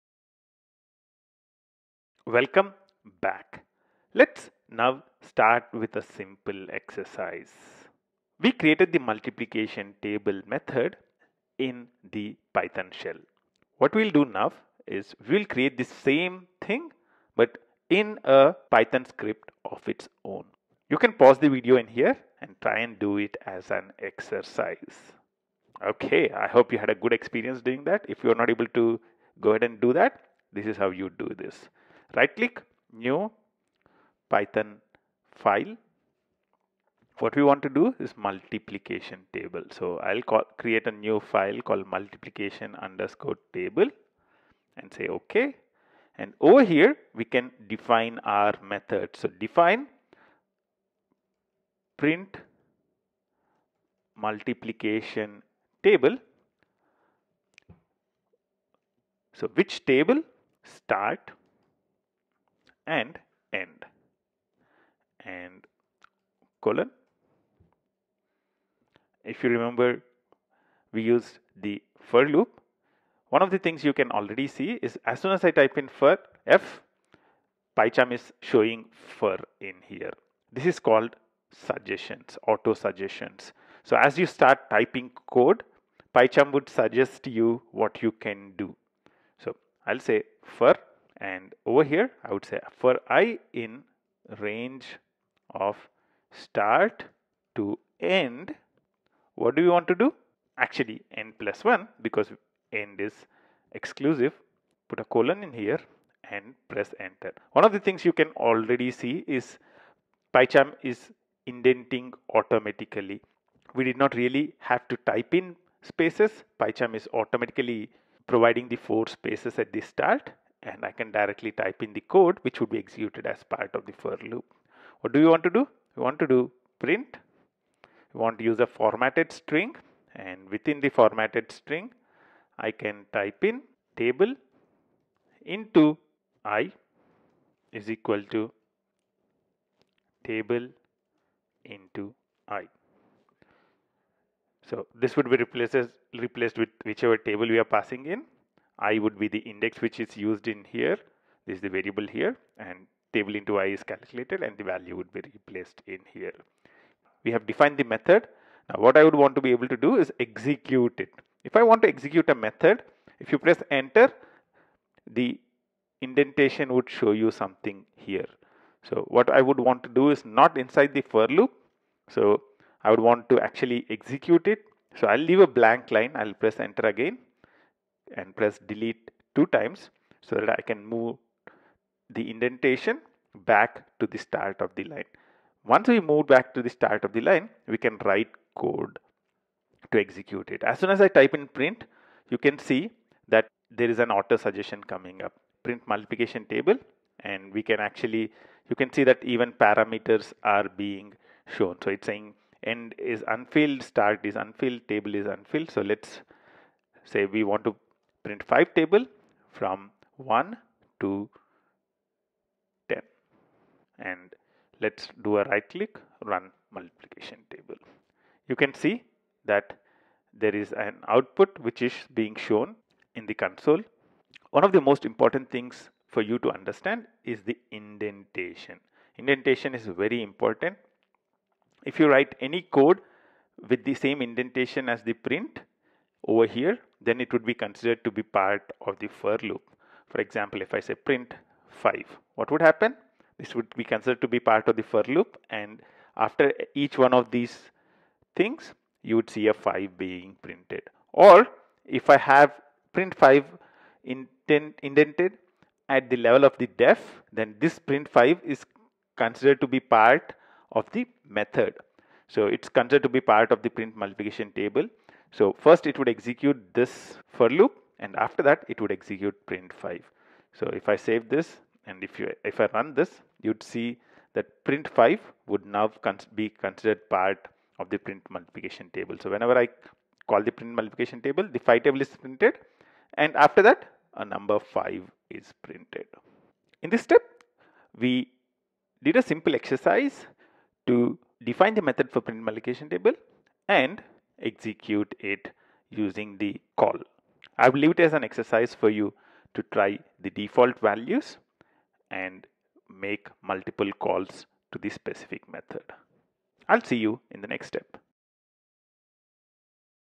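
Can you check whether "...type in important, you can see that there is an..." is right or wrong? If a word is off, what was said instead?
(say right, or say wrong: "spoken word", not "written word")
wrong: "print", not "important".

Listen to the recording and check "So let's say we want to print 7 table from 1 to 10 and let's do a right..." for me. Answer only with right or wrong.
wrong.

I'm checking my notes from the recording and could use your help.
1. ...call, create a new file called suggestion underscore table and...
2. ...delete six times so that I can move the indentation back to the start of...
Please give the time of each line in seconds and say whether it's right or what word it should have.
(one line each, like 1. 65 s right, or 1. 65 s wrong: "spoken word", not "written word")
1. 40 s wrong: "multiplication", not "suggestion"
2. 178 s wrong: "two", not "six".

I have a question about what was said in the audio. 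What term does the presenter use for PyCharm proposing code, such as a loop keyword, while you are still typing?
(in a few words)
auto suggestions.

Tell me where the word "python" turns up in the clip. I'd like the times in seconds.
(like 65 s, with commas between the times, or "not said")
12 s, 18 s, 34 s.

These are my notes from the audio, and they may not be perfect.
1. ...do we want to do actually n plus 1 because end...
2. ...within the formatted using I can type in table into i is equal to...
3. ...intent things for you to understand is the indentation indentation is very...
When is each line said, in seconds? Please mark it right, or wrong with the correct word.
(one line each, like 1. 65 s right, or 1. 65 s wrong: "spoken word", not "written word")
1. 99 s right
2. 130 s wrong: "string", not "using"
3. 225 s wrong: "important", not "intent".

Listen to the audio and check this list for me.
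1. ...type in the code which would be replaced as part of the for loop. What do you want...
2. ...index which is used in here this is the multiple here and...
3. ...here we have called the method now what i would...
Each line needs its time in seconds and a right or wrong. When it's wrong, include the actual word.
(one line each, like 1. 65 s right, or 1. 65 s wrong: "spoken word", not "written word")
1. 121 s wrong: "executed", not "replaced"
2. 149 s wrong: "variable", not "multiple"
3. 156 s wrong: "defined", not "called".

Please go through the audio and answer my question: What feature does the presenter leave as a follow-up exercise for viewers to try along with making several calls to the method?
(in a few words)
default values.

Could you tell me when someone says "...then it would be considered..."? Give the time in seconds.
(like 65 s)
237 s.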